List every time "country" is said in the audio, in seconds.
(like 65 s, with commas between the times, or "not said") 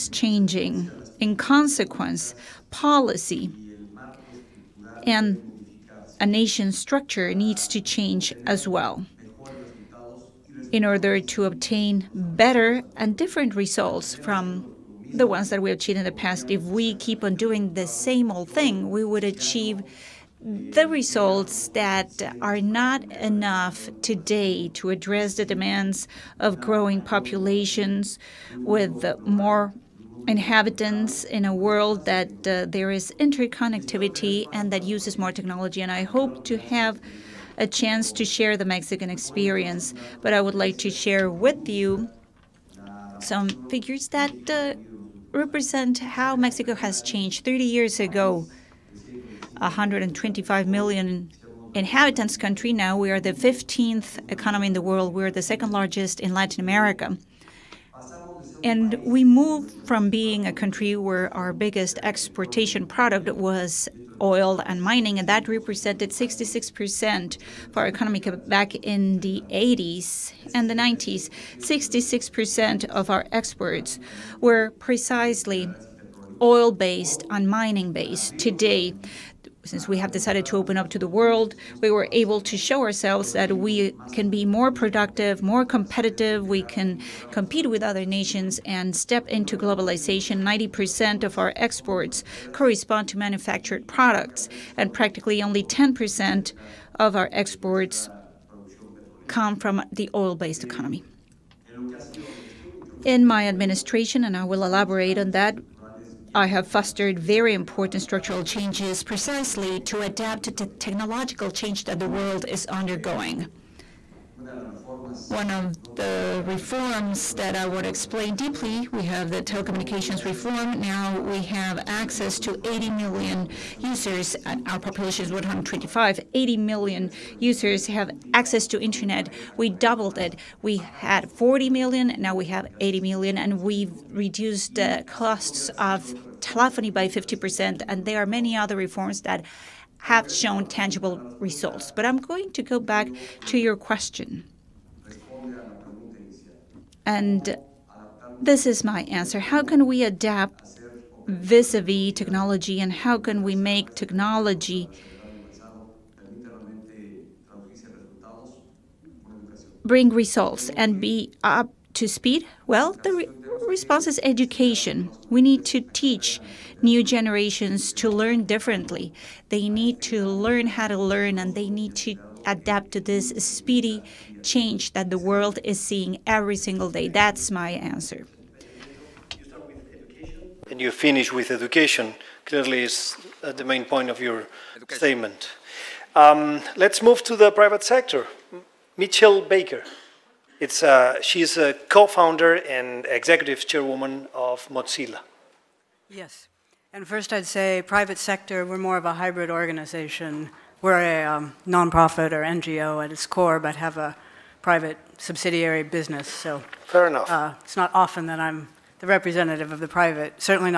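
52 s, 60 s.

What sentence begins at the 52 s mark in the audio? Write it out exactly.
Now we are the 15th economy in the world.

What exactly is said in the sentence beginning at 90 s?
90% of our exports correspond to manufactured products, and practically only 10% of our exports come from the oil based economy.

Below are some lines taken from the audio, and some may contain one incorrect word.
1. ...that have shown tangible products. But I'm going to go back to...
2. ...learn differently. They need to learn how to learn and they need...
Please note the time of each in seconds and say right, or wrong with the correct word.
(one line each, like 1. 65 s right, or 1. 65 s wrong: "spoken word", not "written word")
1. 139 s wrong: "results", not "products"
2. 168 s right.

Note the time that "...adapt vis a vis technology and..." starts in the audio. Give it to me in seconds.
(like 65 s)
150 s.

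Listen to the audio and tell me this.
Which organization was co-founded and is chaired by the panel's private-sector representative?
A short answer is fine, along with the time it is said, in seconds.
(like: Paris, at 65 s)
Mozilla, at 194 s.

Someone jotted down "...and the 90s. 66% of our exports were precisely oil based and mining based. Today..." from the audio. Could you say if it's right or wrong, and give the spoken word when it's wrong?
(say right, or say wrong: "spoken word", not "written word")
right.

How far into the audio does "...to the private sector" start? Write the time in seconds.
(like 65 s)
187 s.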